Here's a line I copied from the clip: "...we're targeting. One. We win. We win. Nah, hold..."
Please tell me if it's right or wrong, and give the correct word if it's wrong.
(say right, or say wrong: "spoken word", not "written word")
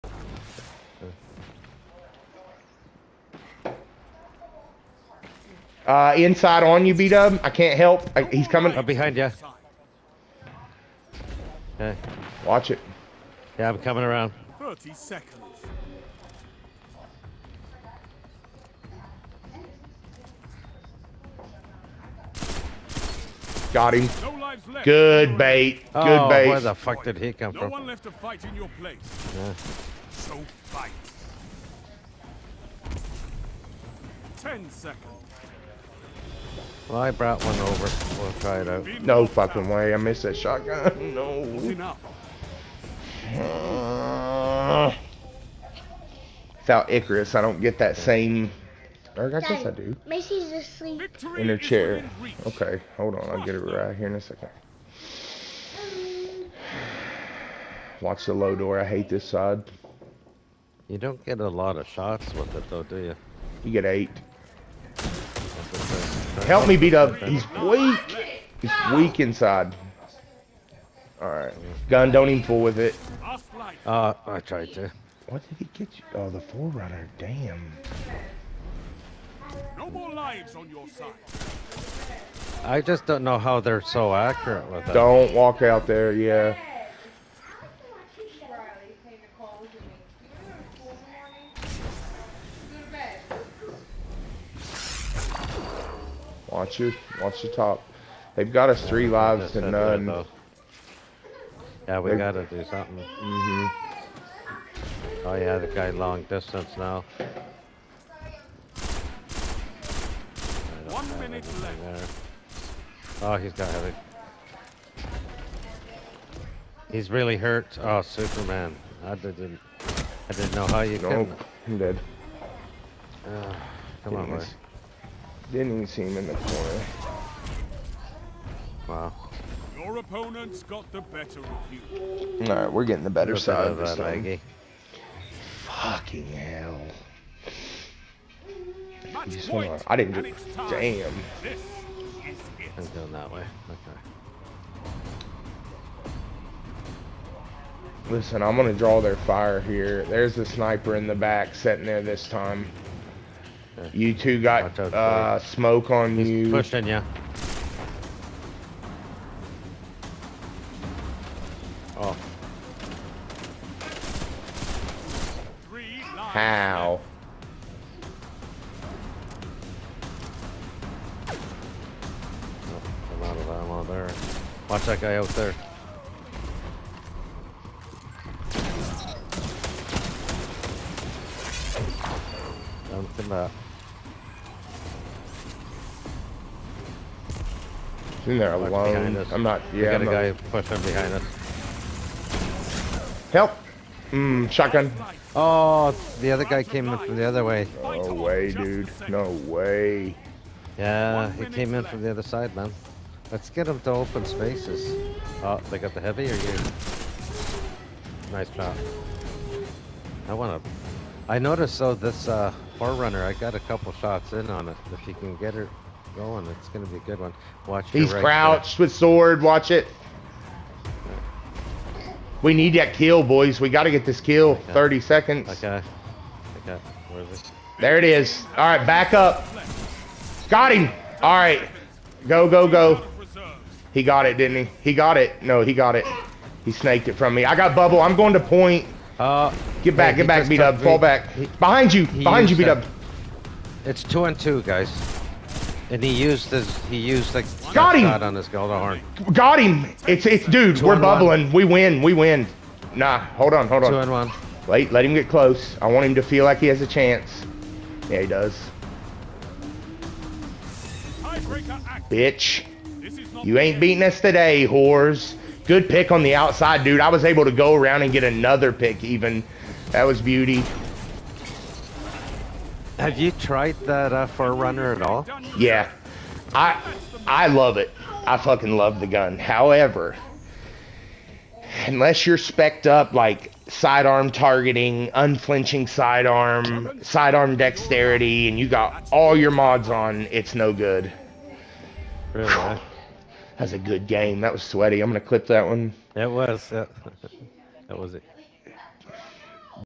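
wrong: "bubbling", not "targeting".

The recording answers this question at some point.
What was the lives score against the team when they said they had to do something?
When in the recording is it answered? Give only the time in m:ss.
1:38.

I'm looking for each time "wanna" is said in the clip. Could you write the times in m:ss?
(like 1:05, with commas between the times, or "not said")
3:30.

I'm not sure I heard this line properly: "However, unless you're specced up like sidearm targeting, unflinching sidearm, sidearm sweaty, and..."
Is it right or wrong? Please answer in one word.
wrong.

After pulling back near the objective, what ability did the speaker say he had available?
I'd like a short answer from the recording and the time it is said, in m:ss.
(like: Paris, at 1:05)
Bubble, at 3:57.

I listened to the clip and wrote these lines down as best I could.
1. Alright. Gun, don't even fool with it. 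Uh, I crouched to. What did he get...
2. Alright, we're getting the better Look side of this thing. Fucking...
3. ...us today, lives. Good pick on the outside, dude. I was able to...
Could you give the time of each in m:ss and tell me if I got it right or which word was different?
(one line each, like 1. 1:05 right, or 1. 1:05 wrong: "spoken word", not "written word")
1. 1:11 wrong: "tried", not "crouched"
2. 2:12 right
3. 4:24 wrong: "whores", not "lives".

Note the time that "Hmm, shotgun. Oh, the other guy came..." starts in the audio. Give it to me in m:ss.
3:14.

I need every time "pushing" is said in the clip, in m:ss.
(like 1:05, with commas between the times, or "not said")
2:36, 3:10.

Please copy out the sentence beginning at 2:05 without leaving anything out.
Didn't even see him in the corner.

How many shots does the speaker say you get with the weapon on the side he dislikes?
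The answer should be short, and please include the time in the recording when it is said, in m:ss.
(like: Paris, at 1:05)
8, at 1:03.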